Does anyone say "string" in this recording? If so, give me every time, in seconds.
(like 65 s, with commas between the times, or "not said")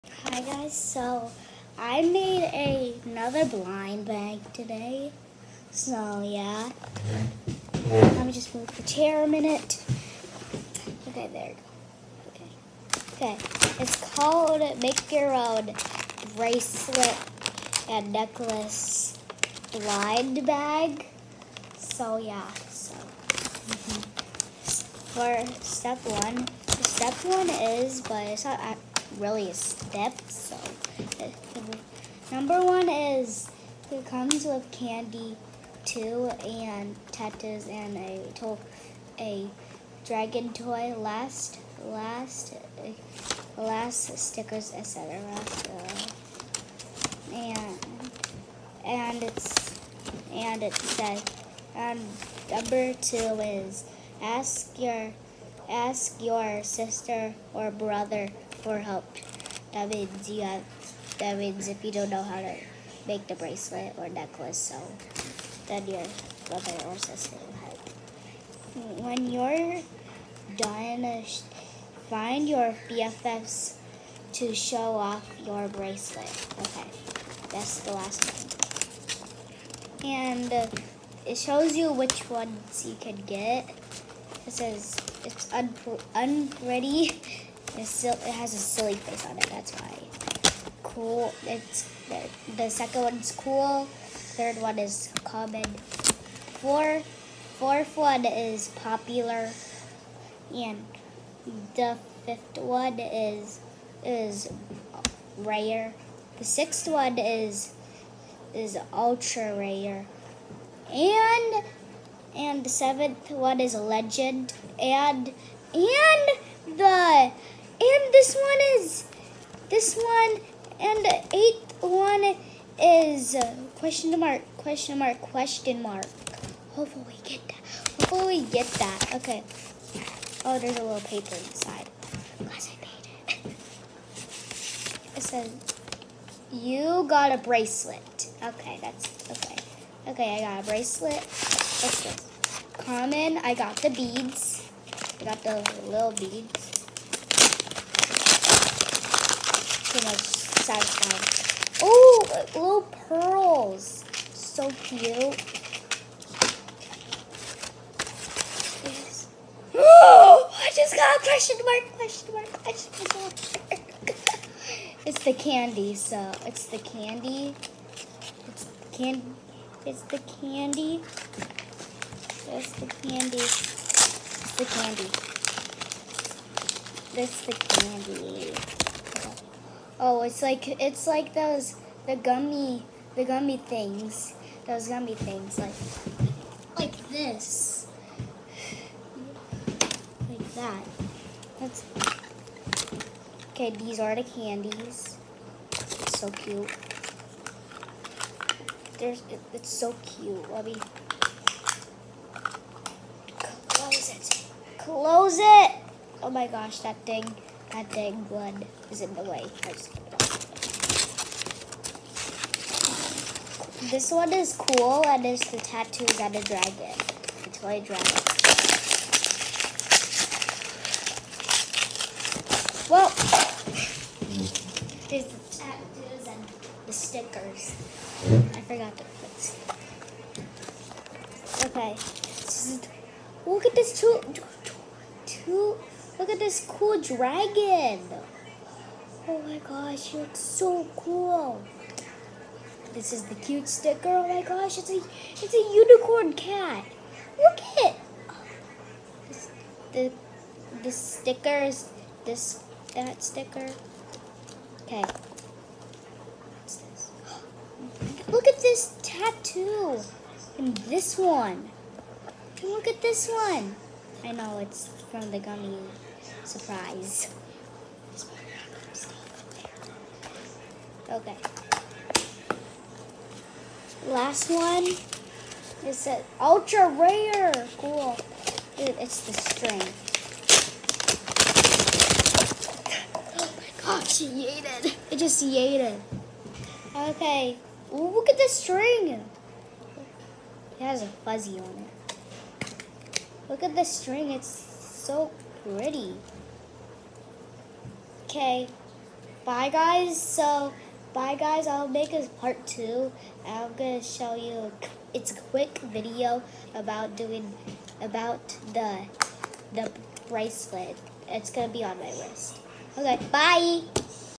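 279 s, 288 s, 293 s.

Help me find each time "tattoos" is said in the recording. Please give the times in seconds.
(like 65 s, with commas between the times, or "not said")
37 s, 215 s, 225 s, 259 s.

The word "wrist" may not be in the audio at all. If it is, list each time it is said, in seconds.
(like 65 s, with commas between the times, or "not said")
312 s.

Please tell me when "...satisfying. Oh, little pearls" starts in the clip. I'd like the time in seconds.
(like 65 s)
150 s.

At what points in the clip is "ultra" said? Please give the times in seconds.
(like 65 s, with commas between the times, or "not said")
108 s, 276 s.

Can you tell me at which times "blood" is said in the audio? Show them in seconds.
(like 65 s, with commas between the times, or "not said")
208 s.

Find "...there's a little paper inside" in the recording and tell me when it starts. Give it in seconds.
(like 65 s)
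130 s.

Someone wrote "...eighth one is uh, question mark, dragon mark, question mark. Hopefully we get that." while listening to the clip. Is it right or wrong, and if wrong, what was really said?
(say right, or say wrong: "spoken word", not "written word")
wrong: "question", not "dragon".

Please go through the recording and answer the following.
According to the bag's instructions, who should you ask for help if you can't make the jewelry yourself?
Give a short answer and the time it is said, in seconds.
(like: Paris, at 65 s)
Sister or brother, at 56 s.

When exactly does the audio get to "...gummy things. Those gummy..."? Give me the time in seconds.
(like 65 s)
183 s.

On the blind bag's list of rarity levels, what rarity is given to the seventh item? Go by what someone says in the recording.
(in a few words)
Legend.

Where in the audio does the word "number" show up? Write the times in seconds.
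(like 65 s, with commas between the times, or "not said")
32 s, 52 s.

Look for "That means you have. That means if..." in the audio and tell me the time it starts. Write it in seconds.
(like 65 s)
59 s.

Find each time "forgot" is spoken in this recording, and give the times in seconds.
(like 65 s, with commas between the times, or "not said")
228 s.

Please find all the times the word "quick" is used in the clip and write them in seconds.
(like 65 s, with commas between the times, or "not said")
305 s.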